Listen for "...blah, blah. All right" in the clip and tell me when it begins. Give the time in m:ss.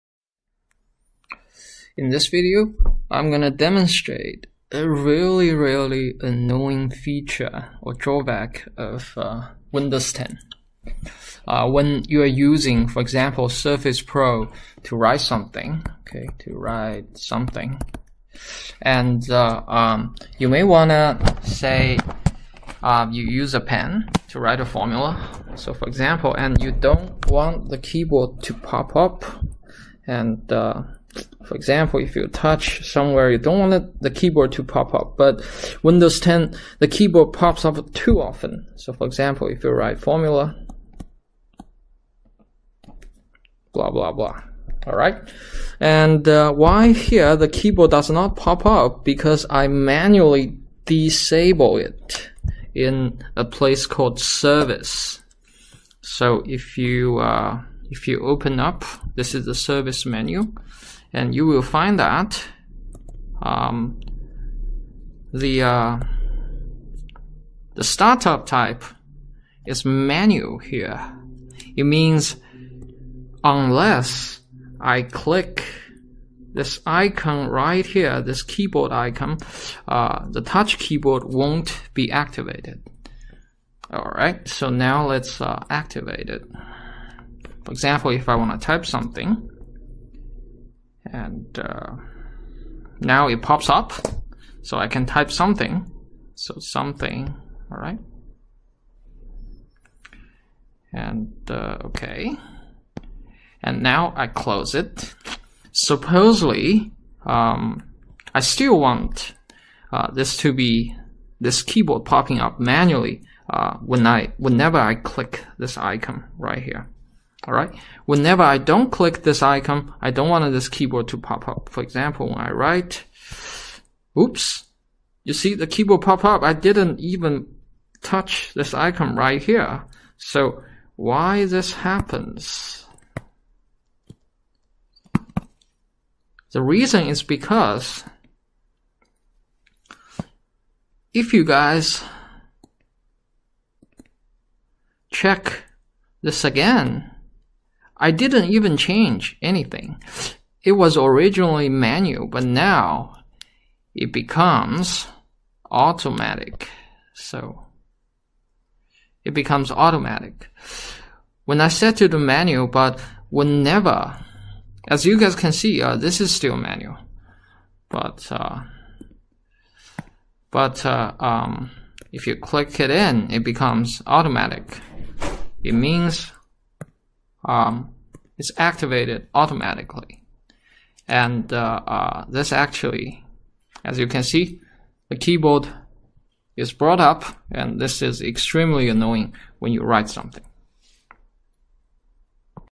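0:43.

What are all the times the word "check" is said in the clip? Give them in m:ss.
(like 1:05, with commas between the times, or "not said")
2:25.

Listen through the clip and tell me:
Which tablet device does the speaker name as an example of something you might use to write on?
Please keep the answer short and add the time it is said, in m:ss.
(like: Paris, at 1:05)
Surface Pro, at 0:13.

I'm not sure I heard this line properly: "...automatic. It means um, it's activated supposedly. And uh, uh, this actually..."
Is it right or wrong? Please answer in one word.
wrong.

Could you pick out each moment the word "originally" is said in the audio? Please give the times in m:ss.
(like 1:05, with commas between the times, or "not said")
2:30.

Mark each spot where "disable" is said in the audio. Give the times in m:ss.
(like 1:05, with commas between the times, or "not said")
0:50.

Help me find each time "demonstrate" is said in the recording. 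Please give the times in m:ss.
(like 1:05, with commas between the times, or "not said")
0:03.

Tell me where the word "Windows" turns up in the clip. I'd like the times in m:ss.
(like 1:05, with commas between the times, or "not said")
0:09, 0:35.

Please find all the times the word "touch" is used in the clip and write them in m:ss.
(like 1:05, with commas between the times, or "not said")
0:32, 1:20, 2:08.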